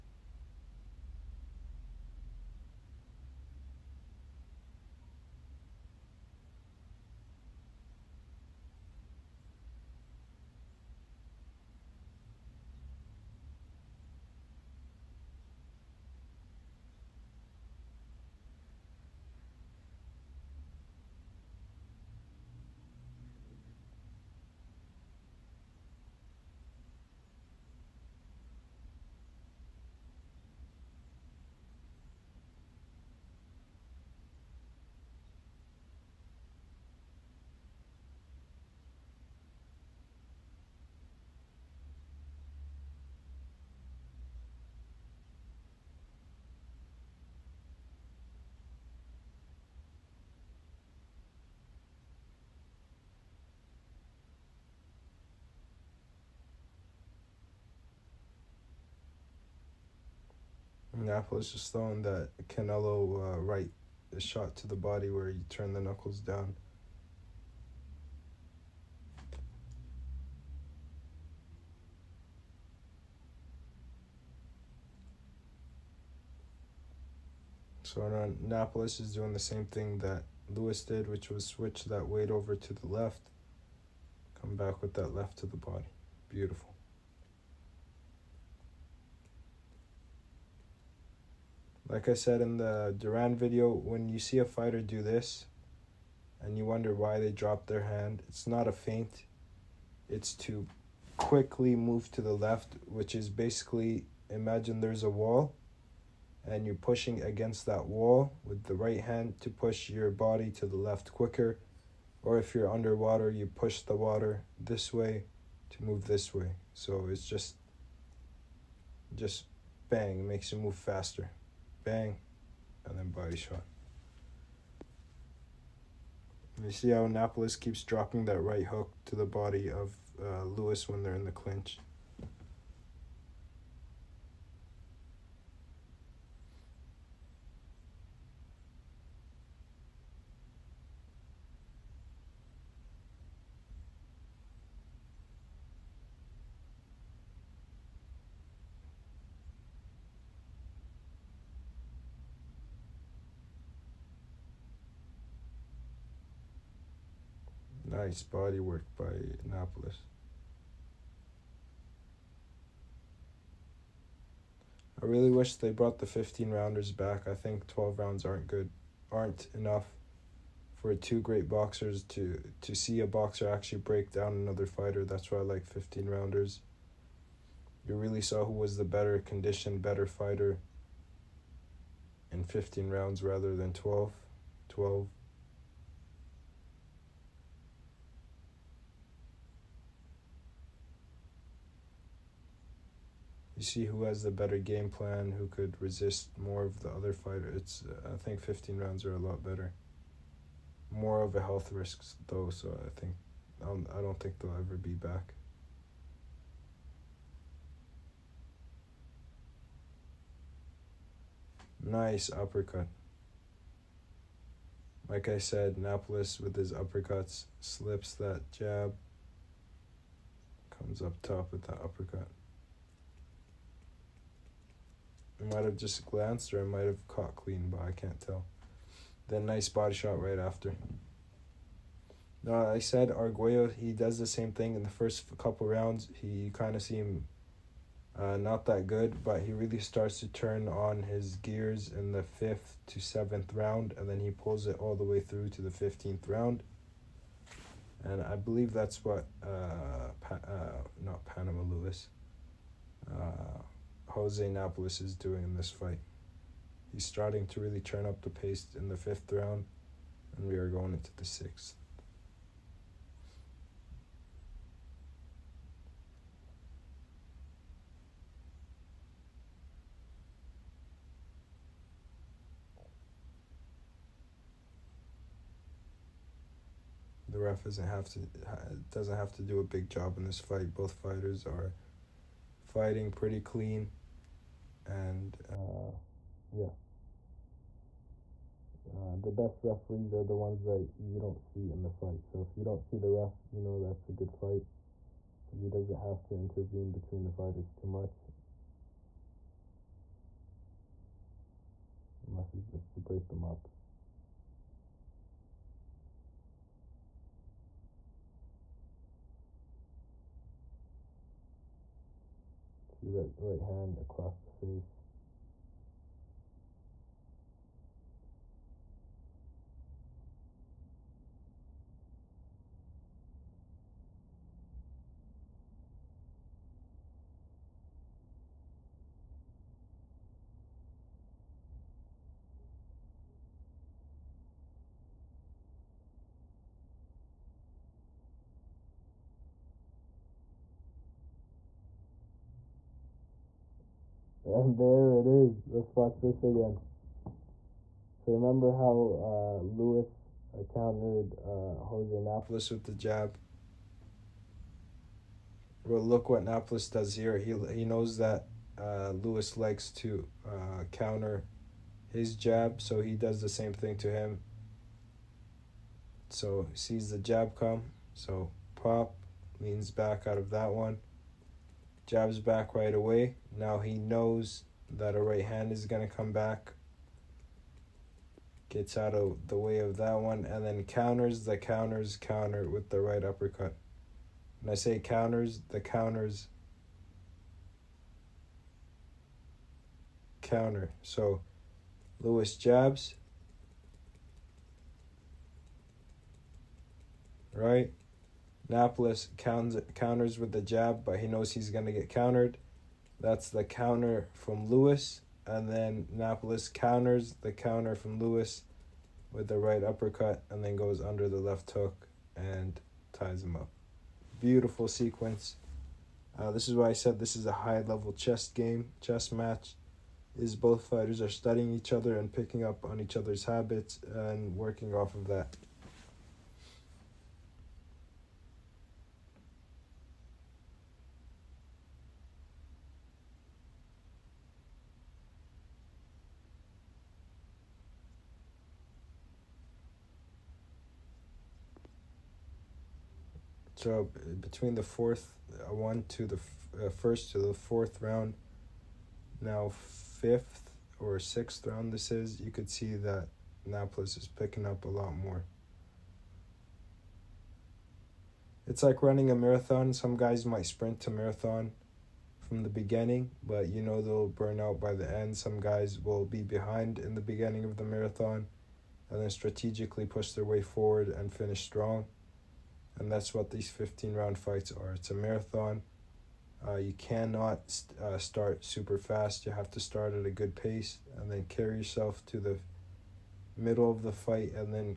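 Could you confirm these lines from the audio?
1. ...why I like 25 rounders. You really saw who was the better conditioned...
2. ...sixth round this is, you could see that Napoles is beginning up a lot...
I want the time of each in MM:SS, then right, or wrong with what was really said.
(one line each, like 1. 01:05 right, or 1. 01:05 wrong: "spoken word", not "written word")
1. 02:55 wrong: "15", not "25"
2. 07:31 wrong: "picking", not "beginning".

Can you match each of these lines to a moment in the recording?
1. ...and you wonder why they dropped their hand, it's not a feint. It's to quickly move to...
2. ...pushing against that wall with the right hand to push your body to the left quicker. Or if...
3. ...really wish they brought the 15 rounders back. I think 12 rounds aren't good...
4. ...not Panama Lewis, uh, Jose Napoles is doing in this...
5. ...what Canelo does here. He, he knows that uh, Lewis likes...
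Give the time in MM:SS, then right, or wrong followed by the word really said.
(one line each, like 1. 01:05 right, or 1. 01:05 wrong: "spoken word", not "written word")
1. 01:36 right
2. 01:46 right
3. 02:45 right
4. 04:11 right
5. 05:56 wrong: "Napoles", not "Canelo".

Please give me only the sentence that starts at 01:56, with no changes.
So it's just, just bang, makes you move faster bang, and then body shot.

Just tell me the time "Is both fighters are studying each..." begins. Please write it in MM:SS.
07:00.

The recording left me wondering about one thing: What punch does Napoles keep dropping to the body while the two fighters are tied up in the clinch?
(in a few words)
Right hook.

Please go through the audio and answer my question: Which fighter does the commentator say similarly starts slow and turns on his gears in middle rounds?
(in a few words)
Arguello.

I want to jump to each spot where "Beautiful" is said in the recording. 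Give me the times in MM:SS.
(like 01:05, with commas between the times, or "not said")
01:26, 06:54.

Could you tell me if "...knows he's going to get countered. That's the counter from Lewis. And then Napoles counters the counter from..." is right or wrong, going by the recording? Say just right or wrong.
right.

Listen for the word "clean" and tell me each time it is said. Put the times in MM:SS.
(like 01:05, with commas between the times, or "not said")
03:47, 04:43.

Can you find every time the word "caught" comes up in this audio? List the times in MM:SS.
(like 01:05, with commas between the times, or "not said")
03:47.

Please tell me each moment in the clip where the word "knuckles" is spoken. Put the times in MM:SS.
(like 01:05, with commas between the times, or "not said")
01:05.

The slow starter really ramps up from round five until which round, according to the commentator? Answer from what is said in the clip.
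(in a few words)
7.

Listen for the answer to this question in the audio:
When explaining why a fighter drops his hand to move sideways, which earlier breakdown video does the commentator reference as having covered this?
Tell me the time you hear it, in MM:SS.
01:32.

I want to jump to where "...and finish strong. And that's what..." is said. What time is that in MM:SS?
07:51.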